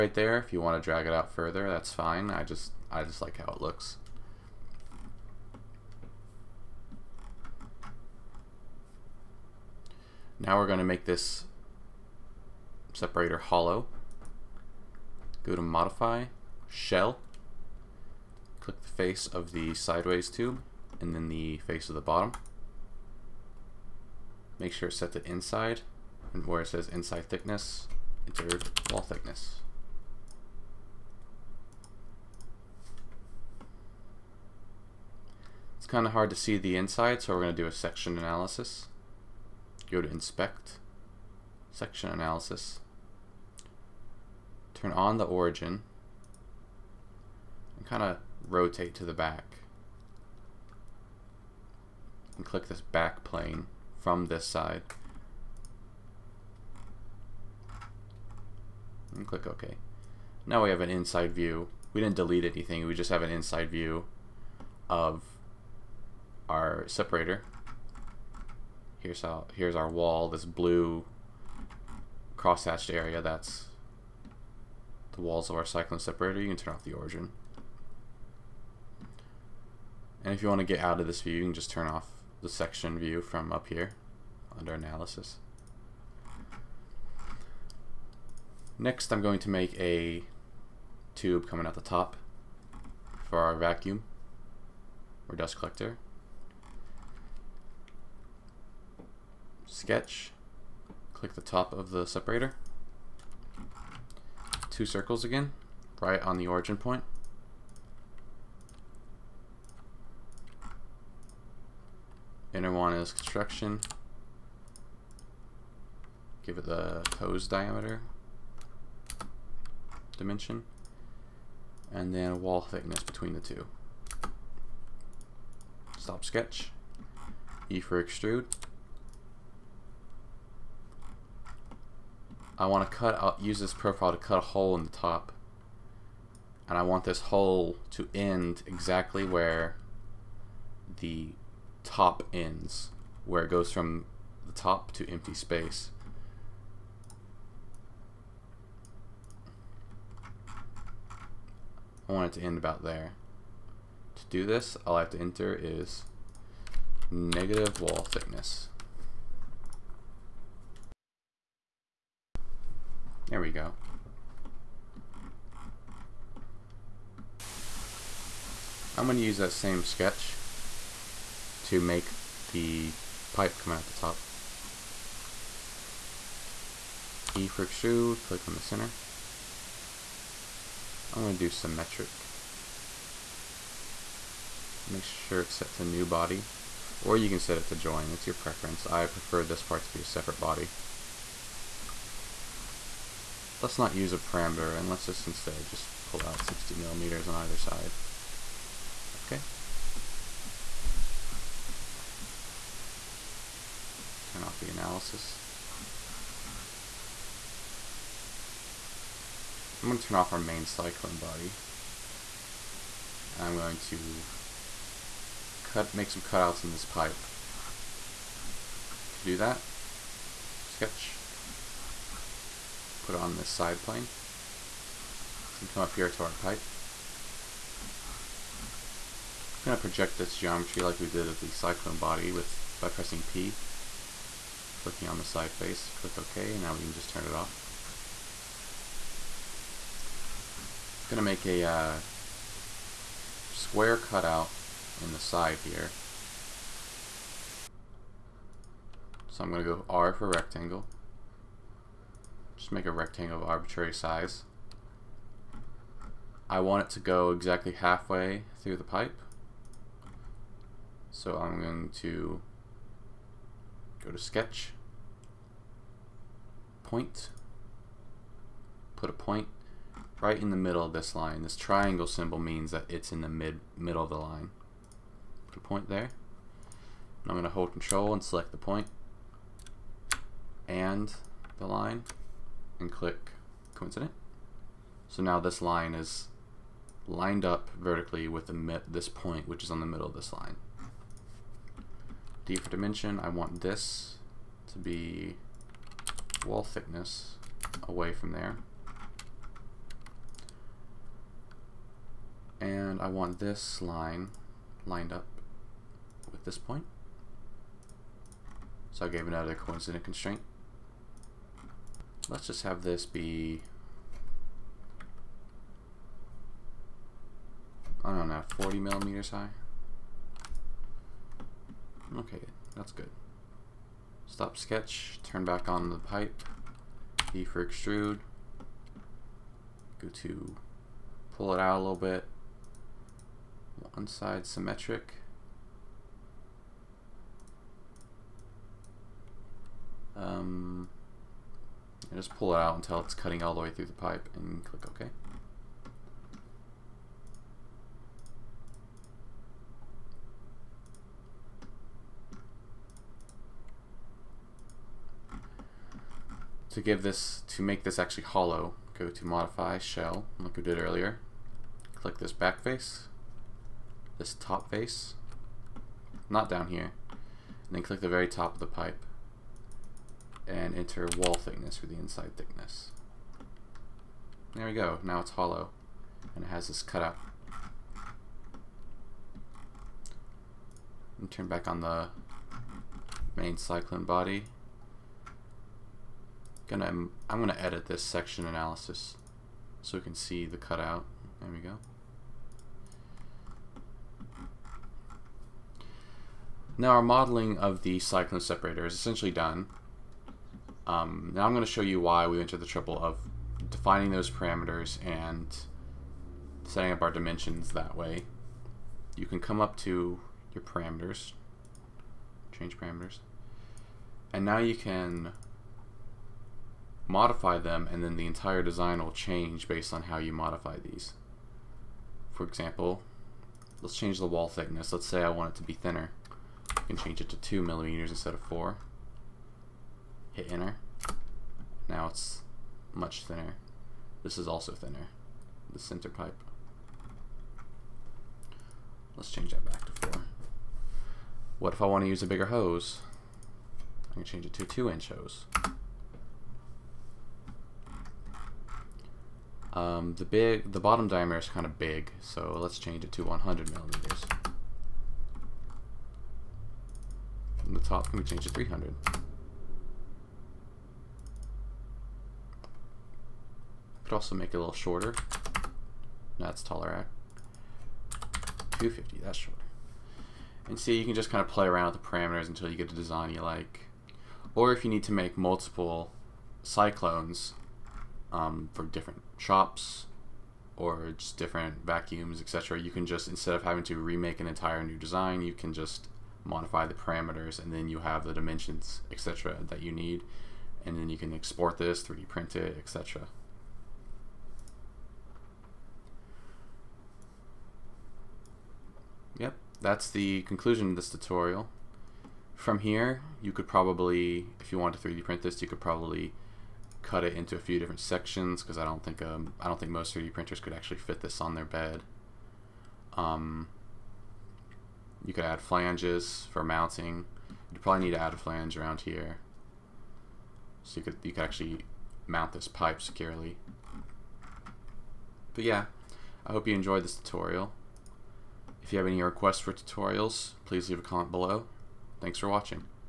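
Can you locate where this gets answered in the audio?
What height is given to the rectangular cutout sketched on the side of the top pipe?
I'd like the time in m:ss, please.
5:18.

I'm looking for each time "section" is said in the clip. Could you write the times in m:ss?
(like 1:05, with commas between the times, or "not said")
0:37, 0:41, 1:22, 6:28, 8:28.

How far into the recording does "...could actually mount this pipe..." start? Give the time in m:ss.
8:41.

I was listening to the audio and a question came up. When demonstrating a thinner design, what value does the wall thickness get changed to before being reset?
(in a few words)
2 millimeters.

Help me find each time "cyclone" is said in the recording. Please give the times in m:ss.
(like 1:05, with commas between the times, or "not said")
1:15, 3:30, 3:51, 6:23, 6:37, 7:56.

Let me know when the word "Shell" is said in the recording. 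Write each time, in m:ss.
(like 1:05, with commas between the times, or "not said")
0:16, 5:59.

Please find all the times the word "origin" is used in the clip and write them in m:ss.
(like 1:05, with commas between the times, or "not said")
0:45, 1:16, 1:46.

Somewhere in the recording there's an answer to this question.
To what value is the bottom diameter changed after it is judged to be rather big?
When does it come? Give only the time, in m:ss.
7:33.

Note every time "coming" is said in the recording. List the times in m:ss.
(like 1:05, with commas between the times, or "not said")
1:31, 2:53.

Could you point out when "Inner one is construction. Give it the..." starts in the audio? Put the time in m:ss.
1:52.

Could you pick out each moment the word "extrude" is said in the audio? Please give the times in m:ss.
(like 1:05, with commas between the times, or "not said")
2:08, 2:57, 5:27.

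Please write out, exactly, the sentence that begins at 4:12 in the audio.
Just make a rectangle of arbitrary size.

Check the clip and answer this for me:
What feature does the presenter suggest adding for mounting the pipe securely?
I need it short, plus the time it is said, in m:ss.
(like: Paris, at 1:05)
flanges, at 8:35.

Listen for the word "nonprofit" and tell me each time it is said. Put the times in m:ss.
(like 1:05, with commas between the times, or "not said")
not said.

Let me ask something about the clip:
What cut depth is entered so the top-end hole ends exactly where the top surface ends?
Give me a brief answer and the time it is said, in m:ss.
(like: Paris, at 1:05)
negative wall thickness, at 2:37.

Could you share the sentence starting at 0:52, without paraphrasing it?
And click this back plane from this side.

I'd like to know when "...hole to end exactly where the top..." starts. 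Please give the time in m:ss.
2:17.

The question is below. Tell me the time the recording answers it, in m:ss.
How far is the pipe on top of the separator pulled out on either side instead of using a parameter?
3:16.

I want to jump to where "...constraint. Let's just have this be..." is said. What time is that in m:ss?
5:10.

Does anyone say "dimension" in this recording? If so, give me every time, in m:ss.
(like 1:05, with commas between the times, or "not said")
2:00, 4:52, 6:47, 8:08.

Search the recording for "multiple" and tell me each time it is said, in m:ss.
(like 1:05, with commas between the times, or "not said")
7:55.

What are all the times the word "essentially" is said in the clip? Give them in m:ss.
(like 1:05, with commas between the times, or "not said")
6:38.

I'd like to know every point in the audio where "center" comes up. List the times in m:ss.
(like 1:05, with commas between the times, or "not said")
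2:58, 7:15.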